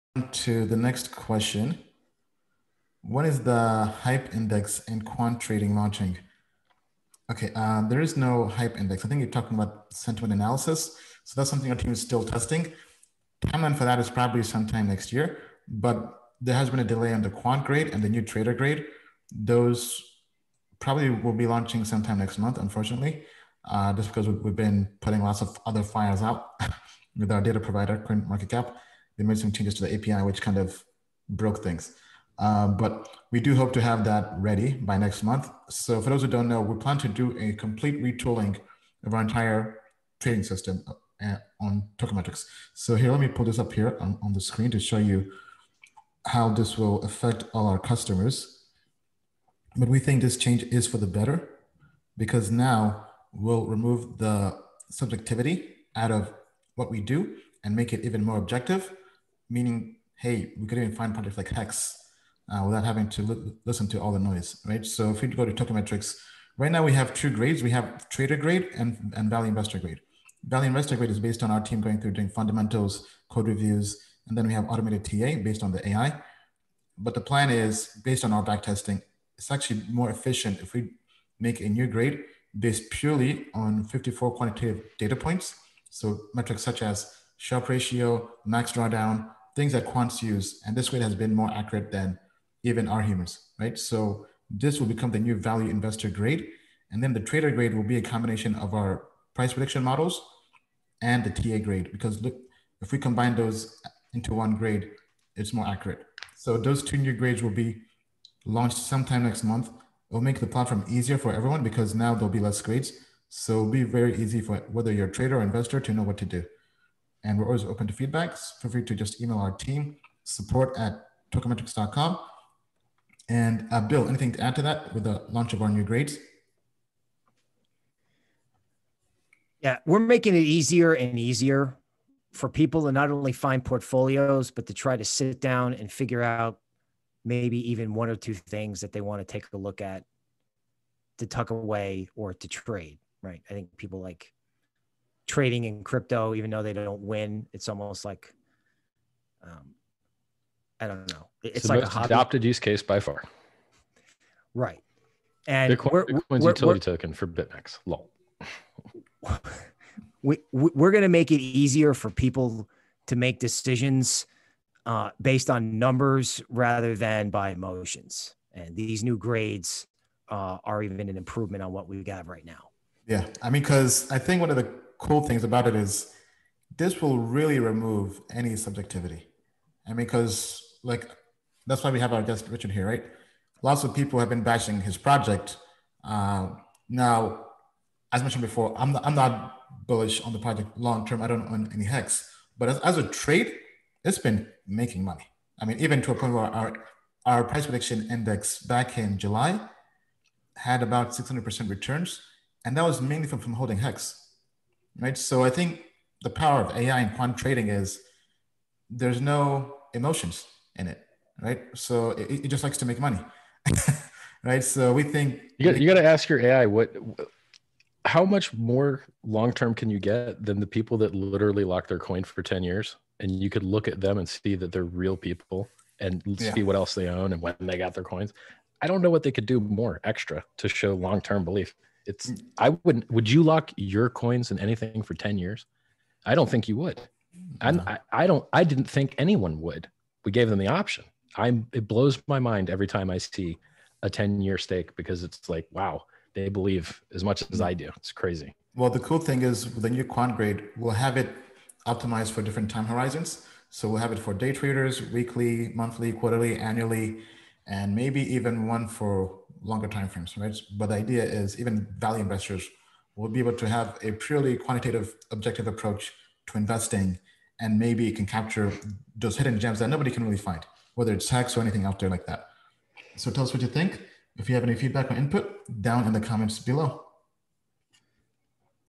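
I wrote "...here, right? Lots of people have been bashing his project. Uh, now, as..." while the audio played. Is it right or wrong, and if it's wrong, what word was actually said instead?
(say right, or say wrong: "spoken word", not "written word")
right.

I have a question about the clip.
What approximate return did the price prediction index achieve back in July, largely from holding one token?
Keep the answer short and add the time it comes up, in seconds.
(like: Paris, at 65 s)
600%, at 201 s.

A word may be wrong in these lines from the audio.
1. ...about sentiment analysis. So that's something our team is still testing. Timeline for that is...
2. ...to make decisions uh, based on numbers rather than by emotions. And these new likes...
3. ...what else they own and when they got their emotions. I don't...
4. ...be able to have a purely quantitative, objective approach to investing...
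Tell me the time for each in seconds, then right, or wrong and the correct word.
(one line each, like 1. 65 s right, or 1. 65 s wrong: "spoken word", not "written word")
1. 9 s right
2. 163 s wrong: "grades", not "likes"
3. 226 s wrong: "coins", not "emotions"
4. 263 s right.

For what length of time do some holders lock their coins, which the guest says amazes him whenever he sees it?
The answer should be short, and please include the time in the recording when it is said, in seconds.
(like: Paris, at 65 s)
10 years, at 222 s.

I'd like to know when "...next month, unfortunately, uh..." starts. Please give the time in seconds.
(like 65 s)
22 s.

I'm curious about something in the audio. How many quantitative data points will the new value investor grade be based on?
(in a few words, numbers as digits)
54.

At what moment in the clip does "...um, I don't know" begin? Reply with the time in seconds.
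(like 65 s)
149 s.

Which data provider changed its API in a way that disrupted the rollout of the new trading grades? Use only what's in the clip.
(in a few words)
CoinMarketCap.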